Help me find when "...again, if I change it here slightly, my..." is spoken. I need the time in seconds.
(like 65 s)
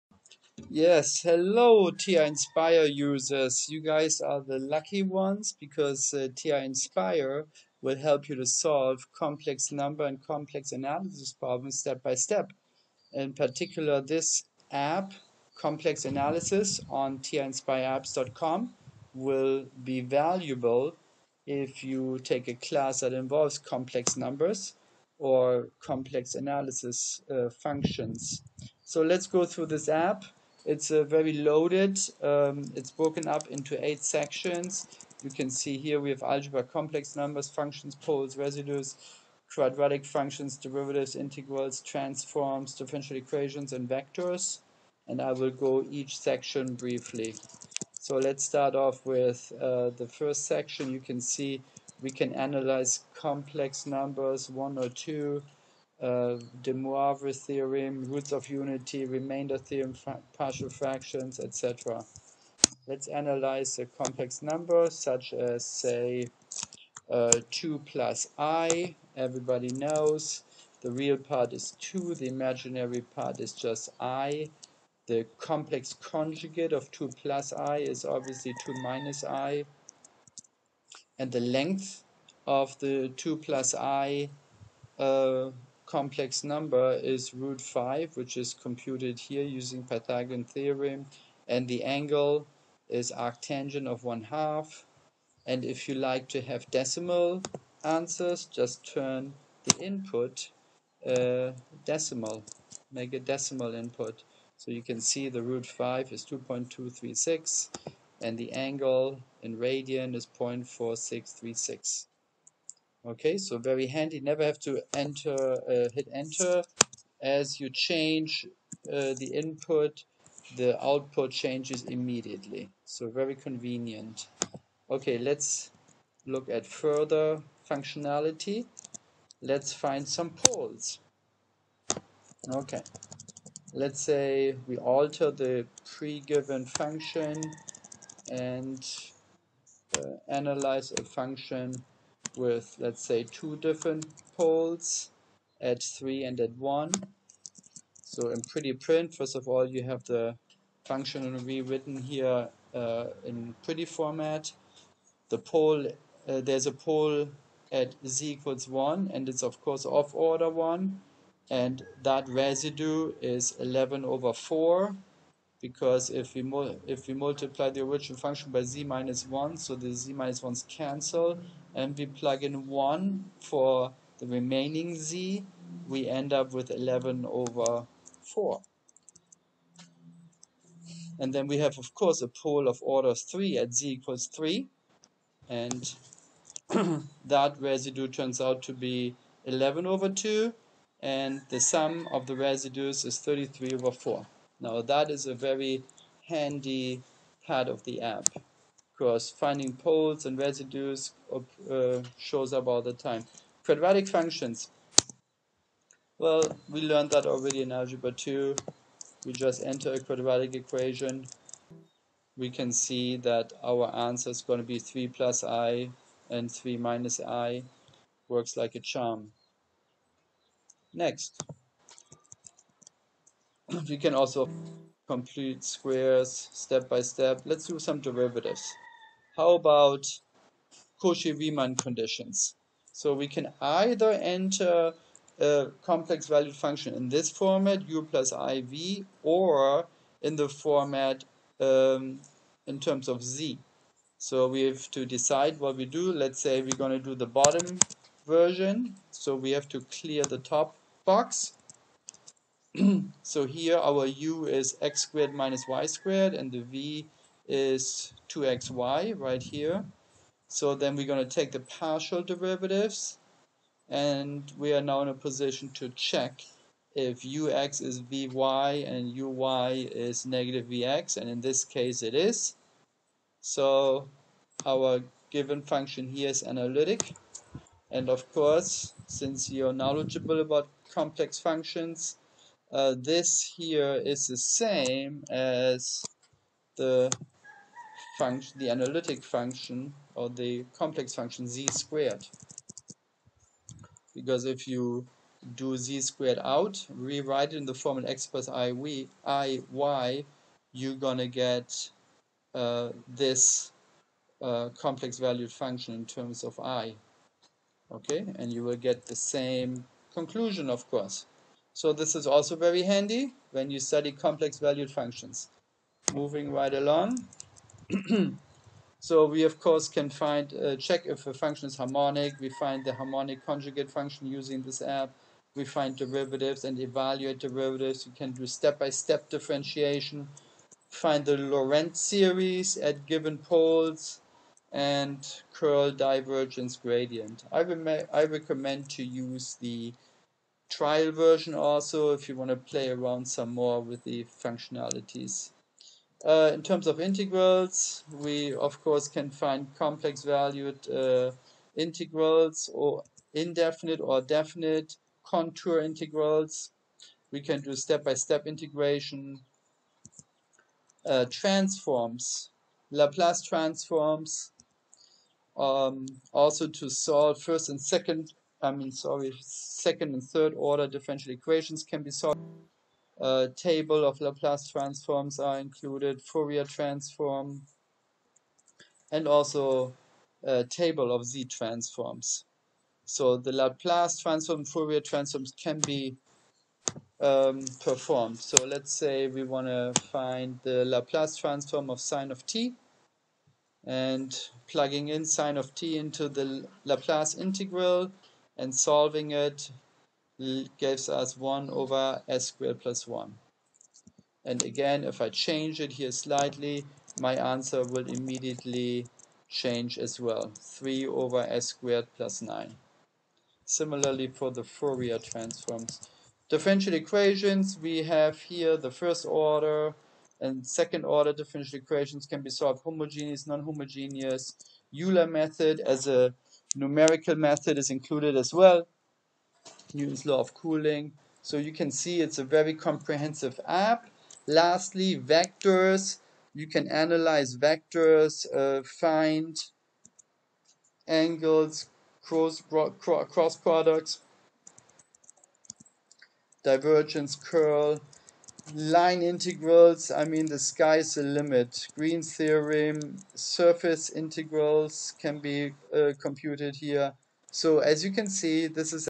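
404 s.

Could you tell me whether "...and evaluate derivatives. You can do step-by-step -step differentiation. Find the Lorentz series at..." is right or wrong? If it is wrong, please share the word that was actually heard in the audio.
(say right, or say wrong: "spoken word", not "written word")
right.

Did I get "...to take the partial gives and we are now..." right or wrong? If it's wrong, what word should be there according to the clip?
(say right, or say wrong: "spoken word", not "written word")
wrong: "derivatives", not "gives".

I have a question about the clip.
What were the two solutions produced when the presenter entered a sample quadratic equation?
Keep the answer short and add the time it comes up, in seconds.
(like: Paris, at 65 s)
3 + i and 3 - i, at 214 s.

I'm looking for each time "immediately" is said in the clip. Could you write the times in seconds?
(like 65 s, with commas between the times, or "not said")
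121 s, 408 s.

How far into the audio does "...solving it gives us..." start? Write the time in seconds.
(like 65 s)
398 s.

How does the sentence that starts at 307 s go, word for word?
Okay, and you will get the same conclusion, of course.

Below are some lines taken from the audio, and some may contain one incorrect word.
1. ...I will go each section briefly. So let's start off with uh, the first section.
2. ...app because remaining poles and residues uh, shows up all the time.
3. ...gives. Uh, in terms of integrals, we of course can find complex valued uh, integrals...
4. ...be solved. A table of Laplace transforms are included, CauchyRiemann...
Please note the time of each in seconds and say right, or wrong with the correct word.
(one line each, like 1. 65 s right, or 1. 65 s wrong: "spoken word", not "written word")
1. 45 s right
2. 198 s wrong: "finding", not "remaining"
3. 344 s wrong: "functionalities", not "gives"
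4. 372 s wrong: "Fourier", not "CauchyRiemann".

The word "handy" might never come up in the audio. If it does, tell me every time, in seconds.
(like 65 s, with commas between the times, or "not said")
113 s, 196 s, 312 s.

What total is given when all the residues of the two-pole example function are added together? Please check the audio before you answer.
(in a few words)
33/4.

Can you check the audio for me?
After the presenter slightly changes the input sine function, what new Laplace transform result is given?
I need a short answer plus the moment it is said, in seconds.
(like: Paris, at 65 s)
3/(s^2 + 9), at 410 s.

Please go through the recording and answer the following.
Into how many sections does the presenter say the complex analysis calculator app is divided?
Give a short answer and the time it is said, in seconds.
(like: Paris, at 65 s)
8, at 33 s.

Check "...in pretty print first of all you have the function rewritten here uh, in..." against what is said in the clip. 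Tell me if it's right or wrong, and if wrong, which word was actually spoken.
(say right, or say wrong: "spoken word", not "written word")
right.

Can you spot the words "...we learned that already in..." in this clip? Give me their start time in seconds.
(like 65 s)
206 s.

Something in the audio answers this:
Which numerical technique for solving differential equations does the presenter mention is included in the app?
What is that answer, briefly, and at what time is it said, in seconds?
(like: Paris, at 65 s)
Euler method, at 425 s.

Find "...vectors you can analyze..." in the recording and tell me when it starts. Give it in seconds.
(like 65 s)
435 s.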